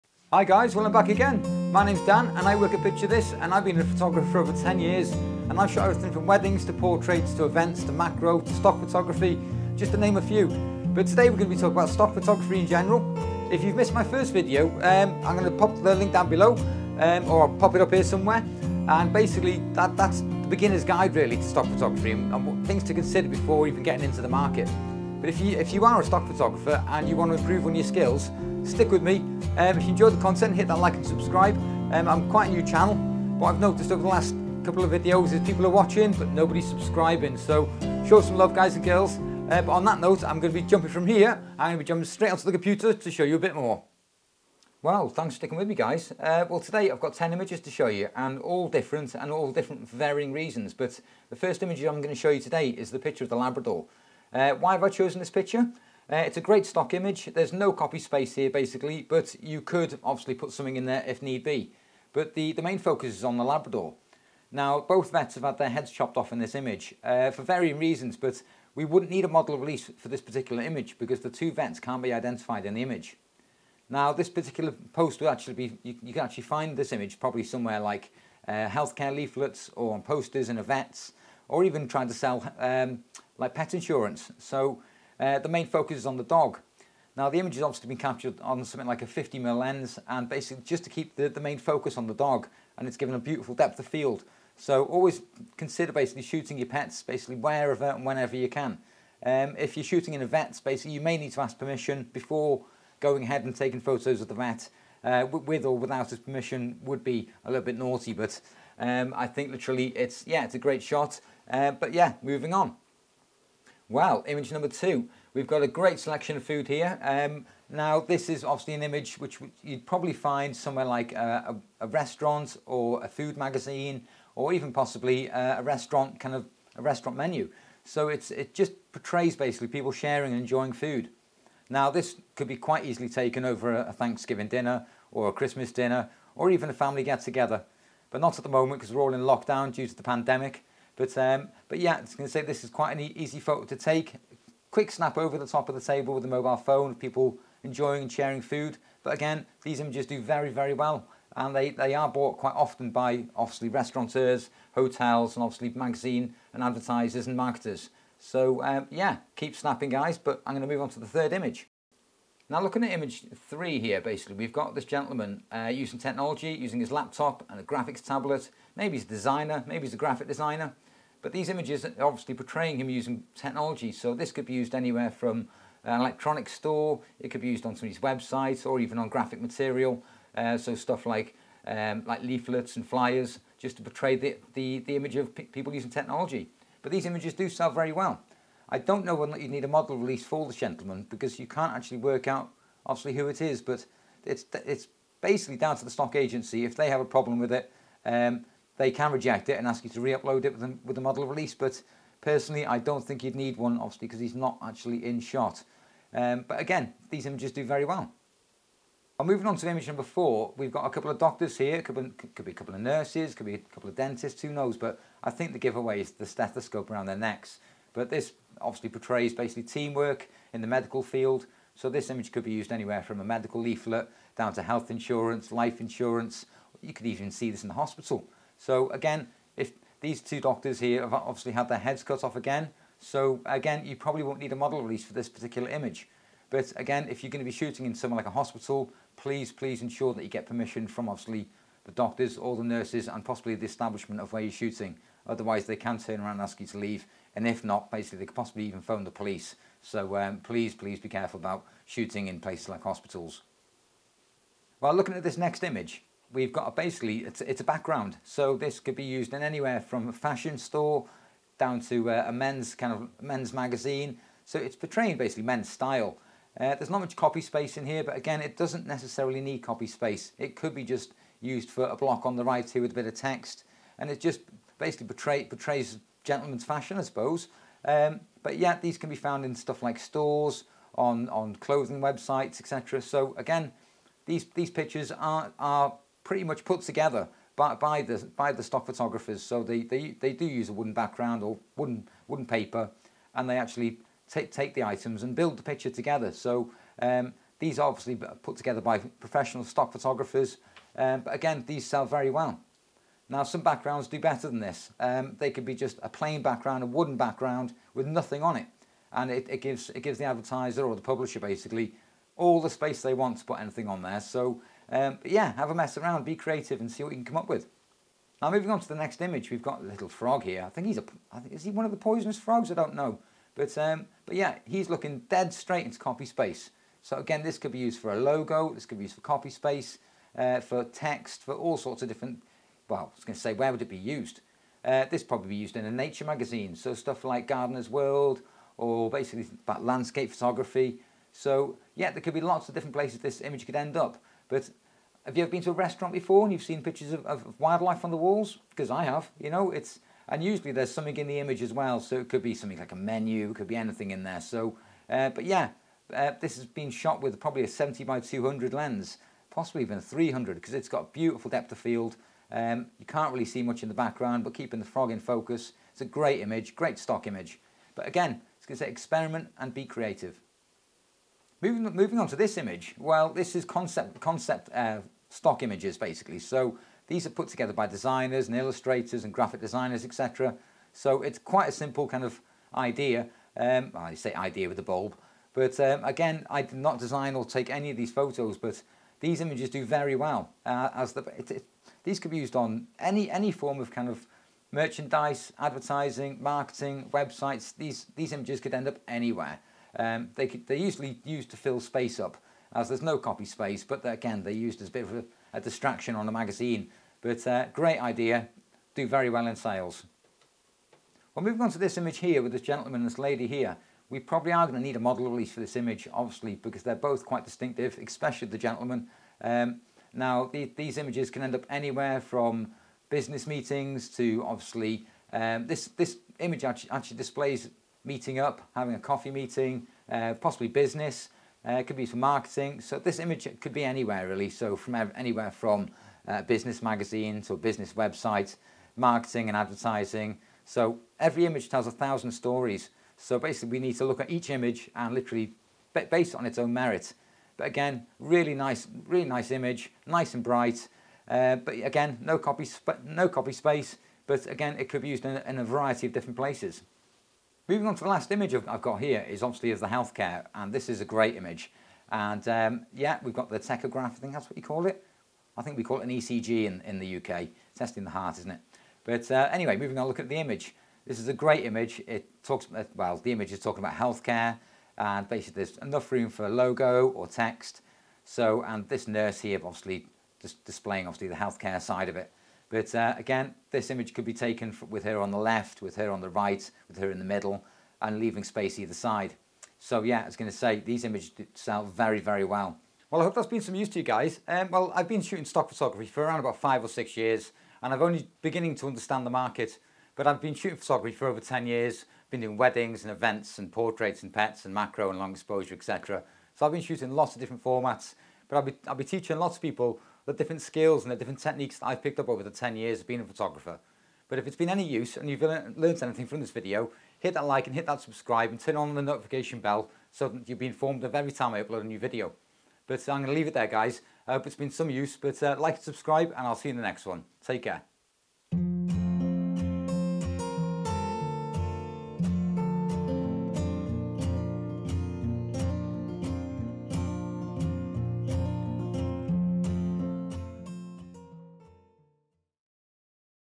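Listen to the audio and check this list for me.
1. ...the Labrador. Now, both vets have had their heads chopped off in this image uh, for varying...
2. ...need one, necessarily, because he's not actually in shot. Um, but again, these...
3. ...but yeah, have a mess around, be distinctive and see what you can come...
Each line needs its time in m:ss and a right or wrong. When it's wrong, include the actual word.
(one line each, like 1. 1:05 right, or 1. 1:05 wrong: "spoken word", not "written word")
1. 1:03 right
2. 3:23 wrong: "obviously", not "necessarily"
3. 5:15 wrong: "creative", not "distinctive".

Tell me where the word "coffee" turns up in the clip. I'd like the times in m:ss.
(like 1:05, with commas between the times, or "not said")
7:08.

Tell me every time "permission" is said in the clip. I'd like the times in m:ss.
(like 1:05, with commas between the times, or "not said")
1:41, 1:46, 4:00.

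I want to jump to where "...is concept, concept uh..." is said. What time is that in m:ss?
6:13.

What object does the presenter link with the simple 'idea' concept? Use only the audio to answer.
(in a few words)
A bulb.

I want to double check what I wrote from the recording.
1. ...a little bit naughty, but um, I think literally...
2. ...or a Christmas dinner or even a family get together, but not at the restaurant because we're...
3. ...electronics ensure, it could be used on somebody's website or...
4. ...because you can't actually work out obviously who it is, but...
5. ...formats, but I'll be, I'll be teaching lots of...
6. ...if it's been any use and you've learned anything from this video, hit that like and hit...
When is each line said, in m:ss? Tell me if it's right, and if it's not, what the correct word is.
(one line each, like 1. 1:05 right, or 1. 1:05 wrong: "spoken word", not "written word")
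1. 1:47 right
2. 2:15 wrong: "moment", not "restaurant"
3. 2:55 wrong: "store", not "ensure"
4. 3:11 right
5. 8:27 right
6. 8:34 right.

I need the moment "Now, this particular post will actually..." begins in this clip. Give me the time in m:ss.
1:13.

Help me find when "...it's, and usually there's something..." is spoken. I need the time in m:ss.
5:49.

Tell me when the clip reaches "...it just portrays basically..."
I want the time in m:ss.
2:08.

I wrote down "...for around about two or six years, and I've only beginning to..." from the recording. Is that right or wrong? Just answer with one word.
wrong.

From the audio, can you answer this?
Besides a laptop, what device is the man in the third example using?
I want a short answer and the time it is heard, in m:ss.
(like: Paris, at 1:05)
Graphics tablet, at 2:47.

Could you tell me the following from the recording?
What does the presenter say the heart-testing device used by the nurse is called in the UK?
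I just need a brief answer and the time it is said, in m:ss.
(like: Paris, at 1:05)
ECG, at 7:46.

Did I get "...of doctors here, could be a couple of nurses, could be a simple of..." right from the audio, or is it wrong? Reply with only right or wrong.
wrong.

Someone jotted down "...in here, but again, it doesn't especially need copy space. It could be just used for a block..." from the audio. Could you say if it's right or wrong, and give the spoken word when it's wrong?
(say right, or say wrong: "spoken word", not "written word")
wrong: "necessarily", not "especially".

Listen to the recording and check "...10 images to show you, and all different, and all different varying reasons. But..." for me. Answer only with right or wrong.
right.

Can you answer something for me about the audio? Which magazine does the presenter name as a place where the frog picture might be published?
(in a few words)
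Gardener's World.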